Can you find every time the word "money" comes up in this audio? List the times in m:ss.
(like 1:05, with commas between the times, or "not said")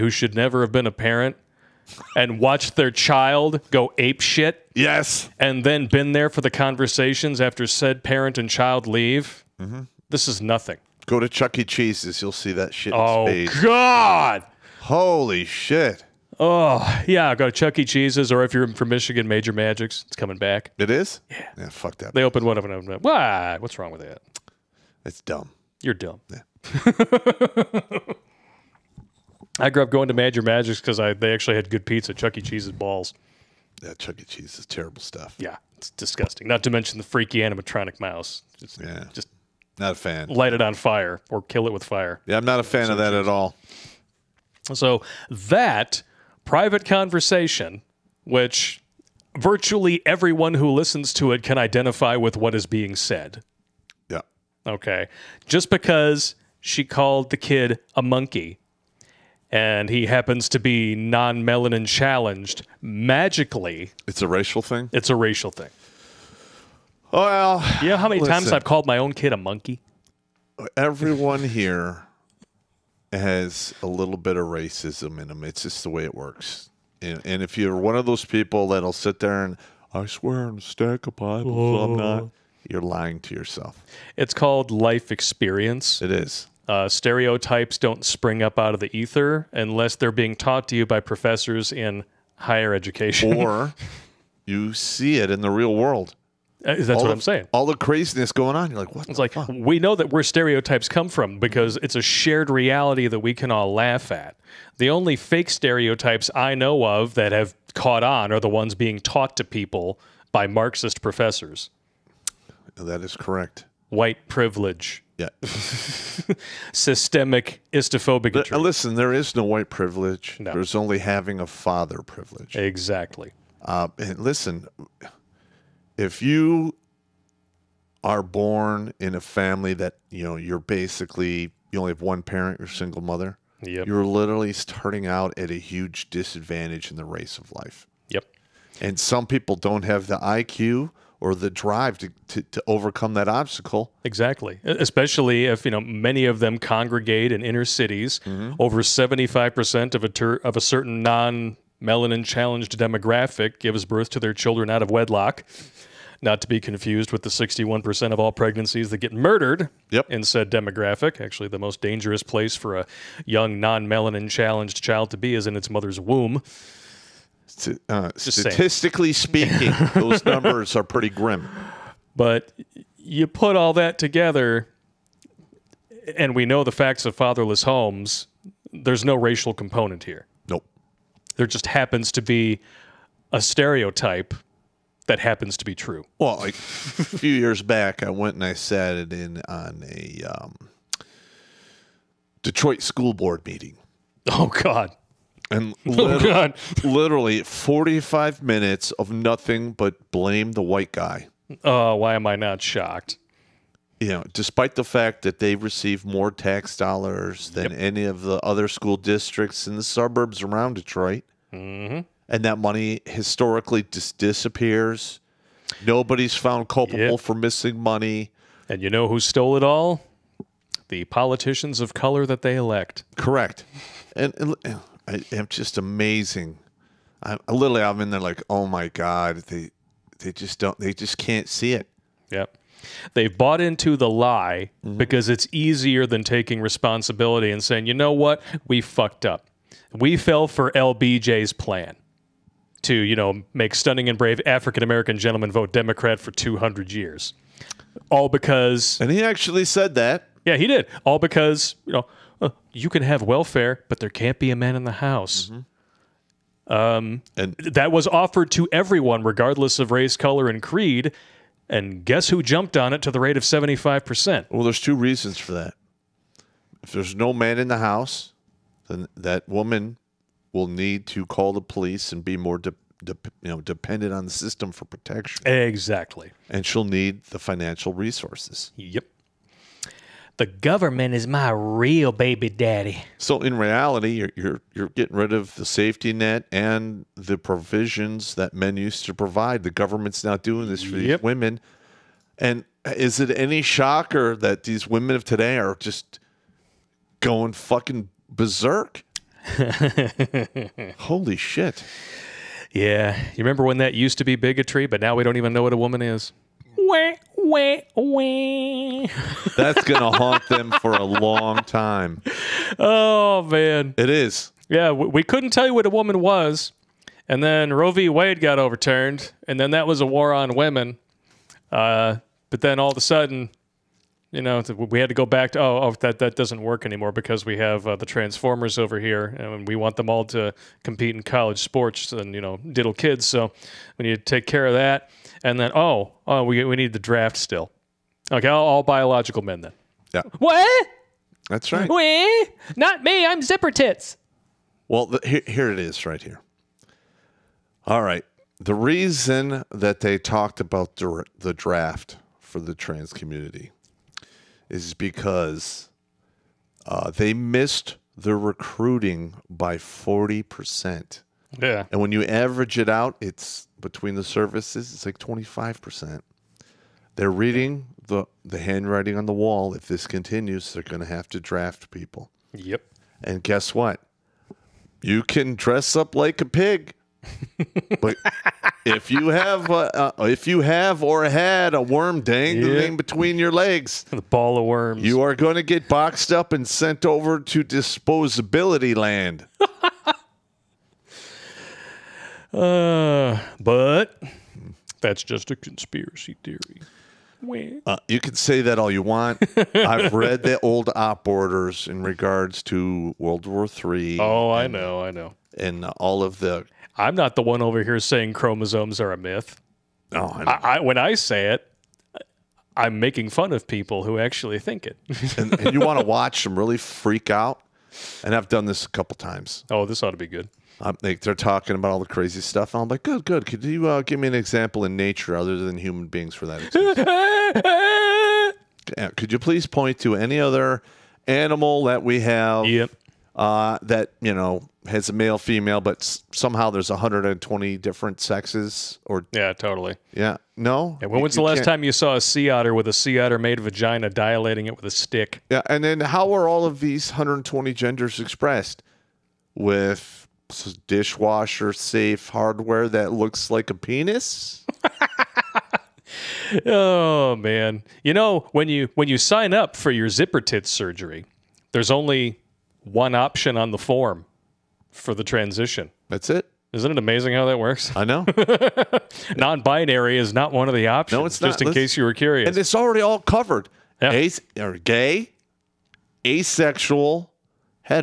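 3:32, 3:37.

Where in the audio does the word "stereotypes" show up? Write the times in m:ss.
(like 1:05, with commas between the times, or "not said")
1:26, 1:40, 1:45, 3:03.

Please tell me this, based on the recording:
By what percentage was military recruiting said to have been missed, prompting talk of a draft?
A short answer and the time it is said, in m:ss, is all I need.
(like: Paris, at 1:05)
40%, at 5:59.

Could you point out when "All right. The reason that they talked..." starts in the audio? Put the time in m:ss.
5:47.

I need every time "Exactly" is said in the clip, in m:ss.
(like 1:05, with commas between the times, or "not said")
2:02, 2:24, 4:35.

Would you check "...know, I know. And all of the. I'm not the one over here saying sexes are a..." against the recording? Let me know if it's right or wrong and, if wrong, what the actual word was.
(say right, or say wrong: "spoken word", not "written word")
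wrong: "chromosomes", not "sexes".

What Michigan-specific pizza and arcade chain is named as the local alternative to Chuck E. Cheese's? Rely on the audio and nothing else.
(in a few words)
Major Magic's.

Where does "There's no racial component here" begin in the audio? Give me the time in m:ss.
2:58.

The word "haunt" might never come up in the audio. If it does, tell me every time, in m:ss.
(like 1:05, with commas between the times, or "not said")
5:10.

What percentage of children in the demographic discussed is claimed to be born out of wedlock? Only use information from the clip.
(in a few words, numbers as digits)
75%.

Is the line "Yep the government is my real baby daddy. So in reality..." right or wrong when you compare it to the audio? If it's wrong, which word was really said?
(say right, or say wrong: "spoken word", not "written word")
right.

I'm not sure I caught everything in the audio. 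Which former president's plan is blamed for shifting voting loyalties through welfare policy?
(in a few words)
LBJ.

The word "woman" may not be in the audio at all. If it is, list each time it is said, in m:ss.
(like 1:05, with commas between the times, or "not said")
4:29, 5:05, 5:15.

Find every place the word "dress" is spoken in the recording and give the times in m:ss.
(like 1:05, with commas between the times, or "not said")
6:15.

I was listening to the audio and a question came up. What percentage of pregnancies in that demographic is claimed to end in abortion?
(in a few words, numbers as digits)
61%.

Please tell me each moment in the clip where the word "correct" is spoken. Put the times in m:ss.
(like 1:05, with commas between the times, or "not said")
1:53, 3:43.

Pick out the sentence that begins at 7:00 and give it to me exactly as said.
Like they, are talking about all the crazy stuff.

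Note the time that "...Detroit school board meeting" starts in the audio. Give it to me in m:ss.
3:12.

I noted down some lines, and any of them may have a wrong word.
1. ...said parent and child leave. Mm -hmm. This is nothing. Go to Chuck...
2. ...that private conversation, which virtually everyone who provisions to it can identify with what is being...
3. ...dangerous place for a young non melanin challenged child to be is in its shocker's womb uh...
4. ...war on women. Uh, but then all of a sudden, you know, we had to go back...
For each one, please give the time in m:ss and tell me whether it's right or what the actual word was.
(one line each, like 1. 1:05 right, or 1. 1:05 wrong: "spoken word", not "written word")
1. 0:07 right
2. 0:45 wrong: "listens", not "provisions"
3. 2:41 wrong: "mother", not "shocker"
4. 5:20 right.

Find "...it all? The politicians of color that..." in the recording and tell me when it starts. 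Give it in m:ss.
3:39.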